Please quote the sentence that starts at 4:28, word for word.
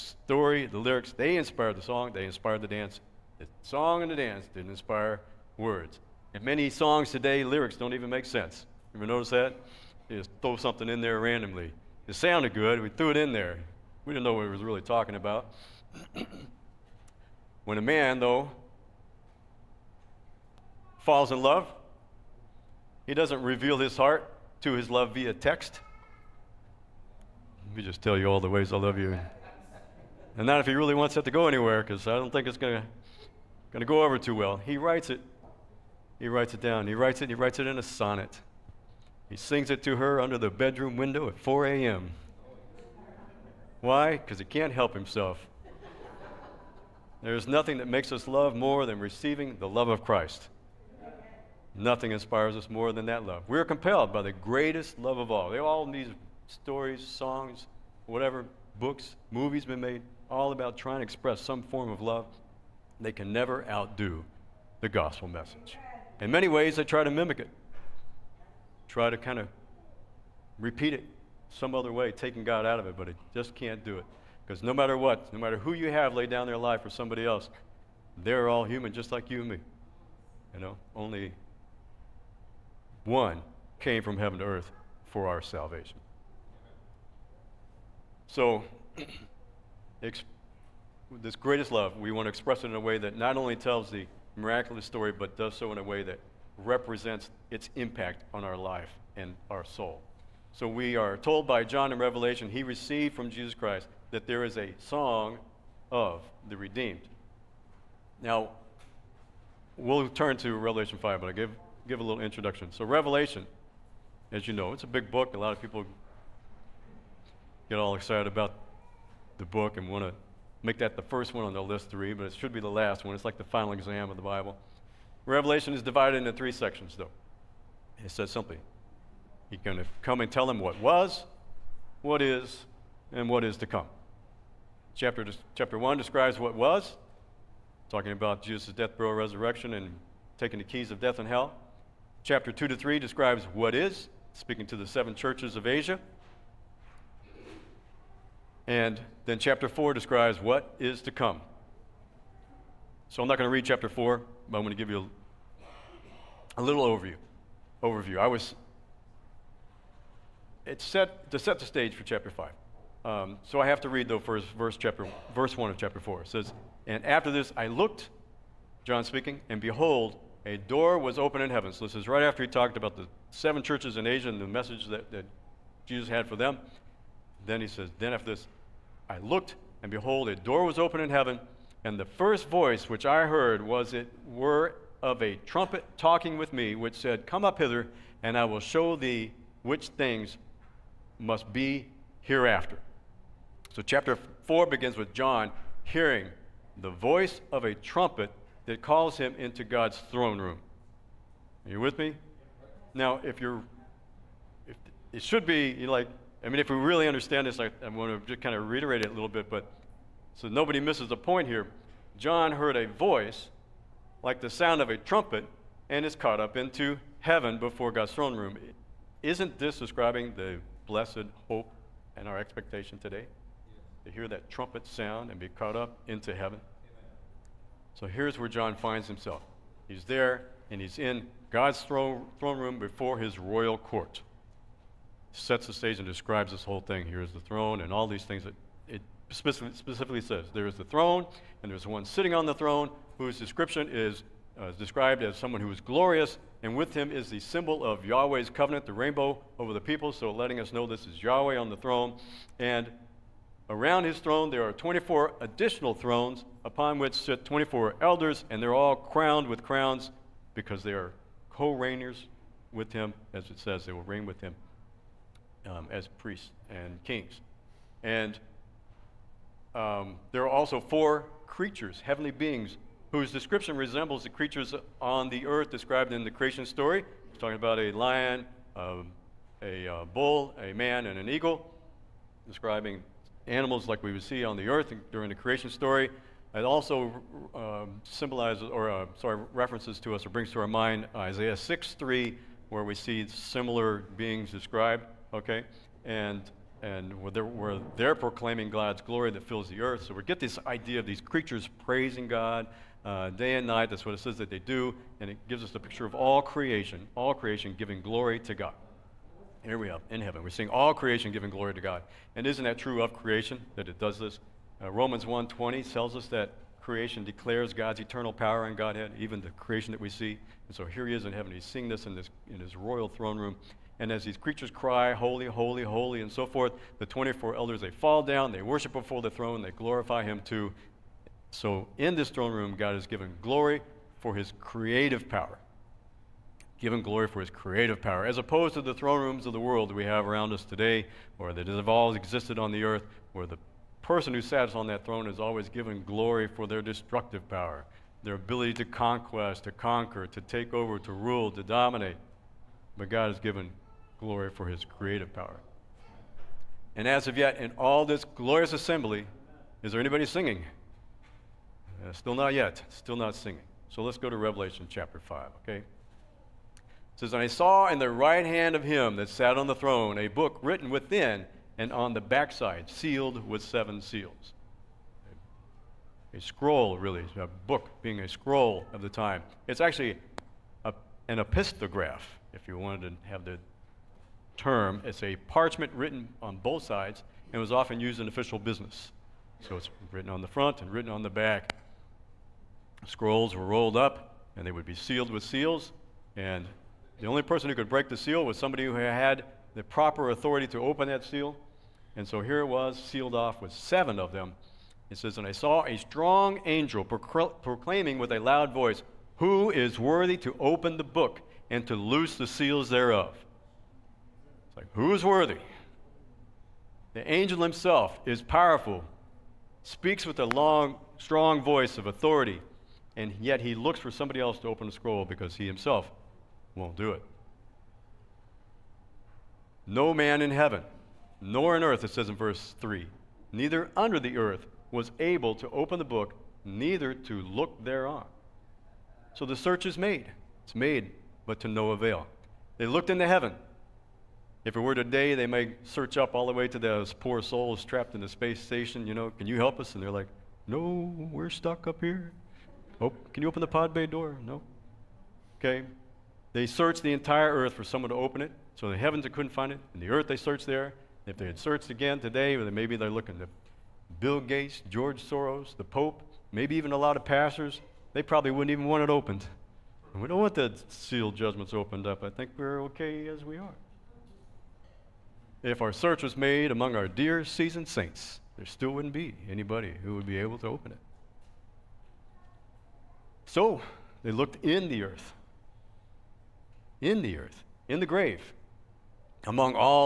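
And um, there are also four creatures, heavenly beings, whose description resembles the creatures on the earth described in the creation story.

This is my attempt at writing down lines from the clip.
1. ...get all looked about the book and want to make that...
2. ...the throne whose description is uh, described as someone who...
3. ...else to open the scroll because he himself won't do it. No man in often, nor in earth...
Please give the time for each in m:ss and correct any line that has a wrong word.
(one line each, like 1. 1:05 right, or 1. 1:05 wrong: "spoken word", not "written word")
1. 1:57 wrong: "excited", not "looked"
2. 4:02 right
3. 7:04 wrong: "heaven", not "often".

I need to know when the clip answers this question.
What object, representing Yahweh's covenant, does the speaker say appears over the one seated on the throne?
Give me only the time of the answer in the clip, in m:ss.
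4:08.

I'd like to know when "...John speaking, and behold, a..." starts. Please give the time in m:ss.
2:48.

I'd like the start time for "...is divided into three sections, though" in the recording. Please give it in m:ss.
2:05.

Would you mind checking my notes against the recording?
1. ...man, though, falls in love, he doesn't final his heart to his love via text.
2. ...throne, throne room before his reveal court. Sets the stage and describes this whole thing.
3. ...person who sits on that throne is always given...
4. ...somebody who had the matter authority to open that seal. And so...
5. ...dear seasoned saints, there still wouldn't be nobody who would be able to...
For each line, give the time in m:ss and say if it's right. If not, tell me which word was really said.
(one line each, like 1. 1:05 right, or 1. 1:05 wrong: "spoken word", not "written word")
1. 0:17 wrong: "reveal", not "final"
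2. 3:51 wrong: "royal", not "reveal"
3. 5:44 right
4. 6:38 wrong: "proper", not "matter"
5. 7:57 wrong: "anybody", not "nobody".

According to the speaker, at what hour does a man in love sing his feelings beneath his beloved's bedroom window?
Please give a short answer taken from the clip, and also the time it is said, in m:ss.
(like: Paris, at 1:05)
4 a.m., at 0:41.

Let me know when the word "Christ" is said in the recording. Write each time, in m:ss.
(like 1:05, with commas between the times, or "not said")
0:50, 1:43.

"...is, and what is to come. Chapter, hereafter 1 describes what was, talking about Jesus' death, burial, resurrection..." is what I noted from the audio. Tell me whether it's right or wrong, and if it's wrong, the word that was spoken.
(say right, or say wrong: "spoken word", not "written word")
wrong: "chapter", not "hereafter".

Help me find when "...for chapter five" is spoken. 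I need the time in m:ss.
2:41.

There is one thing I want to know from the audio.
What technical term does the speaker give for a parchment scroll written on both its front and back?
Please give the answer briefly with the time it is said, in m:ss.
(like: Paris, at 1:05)
epistograph, at 6:21.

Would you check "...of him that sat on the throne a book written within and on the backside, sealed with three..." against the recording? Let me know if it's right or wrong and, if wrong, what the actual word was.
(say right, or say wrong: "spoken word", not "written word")
wrong: "seven", not "three".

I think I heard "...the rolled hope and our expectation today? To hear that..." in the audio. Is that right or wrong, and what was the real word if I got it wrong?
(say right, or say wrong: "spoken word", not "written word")
wrong: "blessed", not "rolled".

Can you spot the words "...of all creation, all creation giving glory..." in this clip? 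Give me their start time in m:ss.
5:06.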